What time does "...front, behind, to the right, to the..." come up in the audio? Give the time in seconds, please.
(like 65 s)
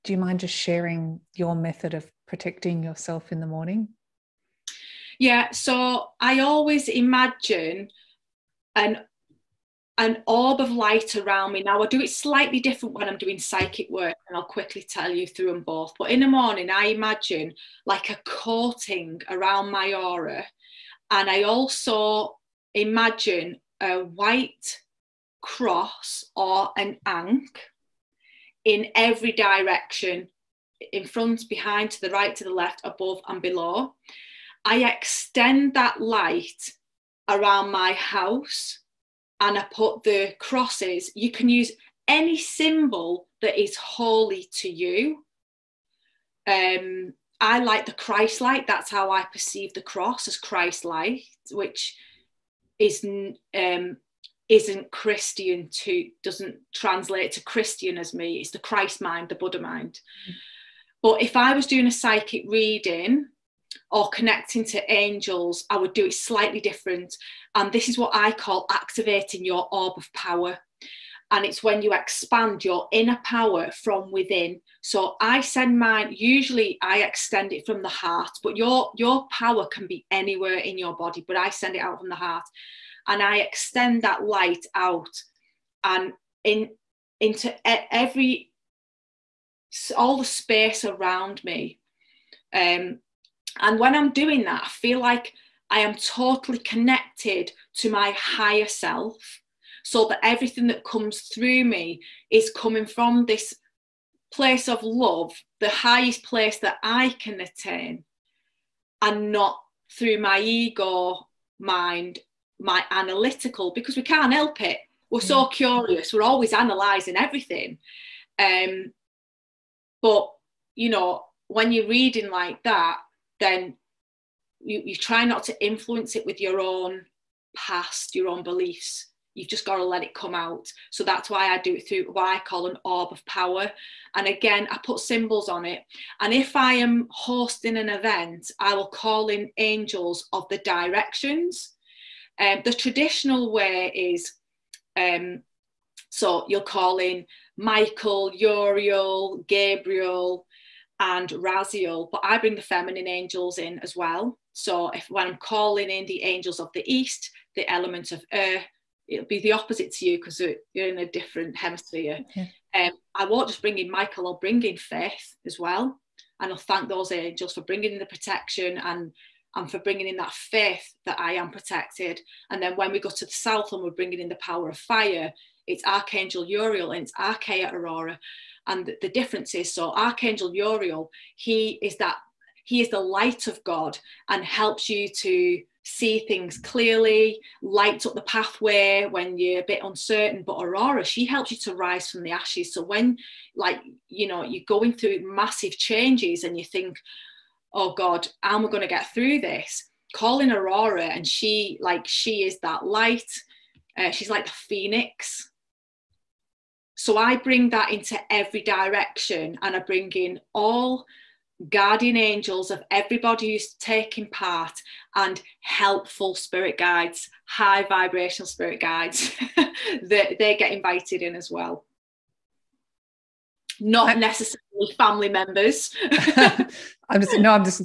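31 s.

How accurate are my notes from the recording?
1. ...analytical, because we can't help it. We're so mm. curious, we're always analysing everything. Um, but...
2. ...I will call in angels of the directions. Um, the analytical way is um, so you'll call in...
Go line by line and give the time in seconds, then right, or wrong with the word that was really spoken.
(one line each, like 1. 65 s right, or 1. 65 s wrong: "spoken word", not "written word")
1. 112 s right
2. 138 s wrong: "traditional", not "analytical".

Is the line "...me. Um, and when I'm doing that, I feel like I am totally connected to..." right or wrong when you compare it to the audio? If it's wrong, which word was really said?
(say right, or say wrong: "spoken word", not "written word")
right.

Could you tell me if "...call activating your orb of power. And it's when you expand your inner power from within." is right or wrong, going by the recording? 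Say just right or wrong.
right.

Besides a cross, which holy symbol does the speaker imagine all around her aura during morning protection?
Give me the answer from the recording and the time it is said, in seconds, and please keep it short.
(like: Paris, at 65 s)
Ankh, at 26 s.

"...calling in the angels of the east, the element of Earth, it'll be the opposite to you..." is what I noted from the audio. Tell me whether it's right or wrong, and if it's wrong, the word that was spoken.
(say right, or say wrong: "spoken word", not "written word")
right.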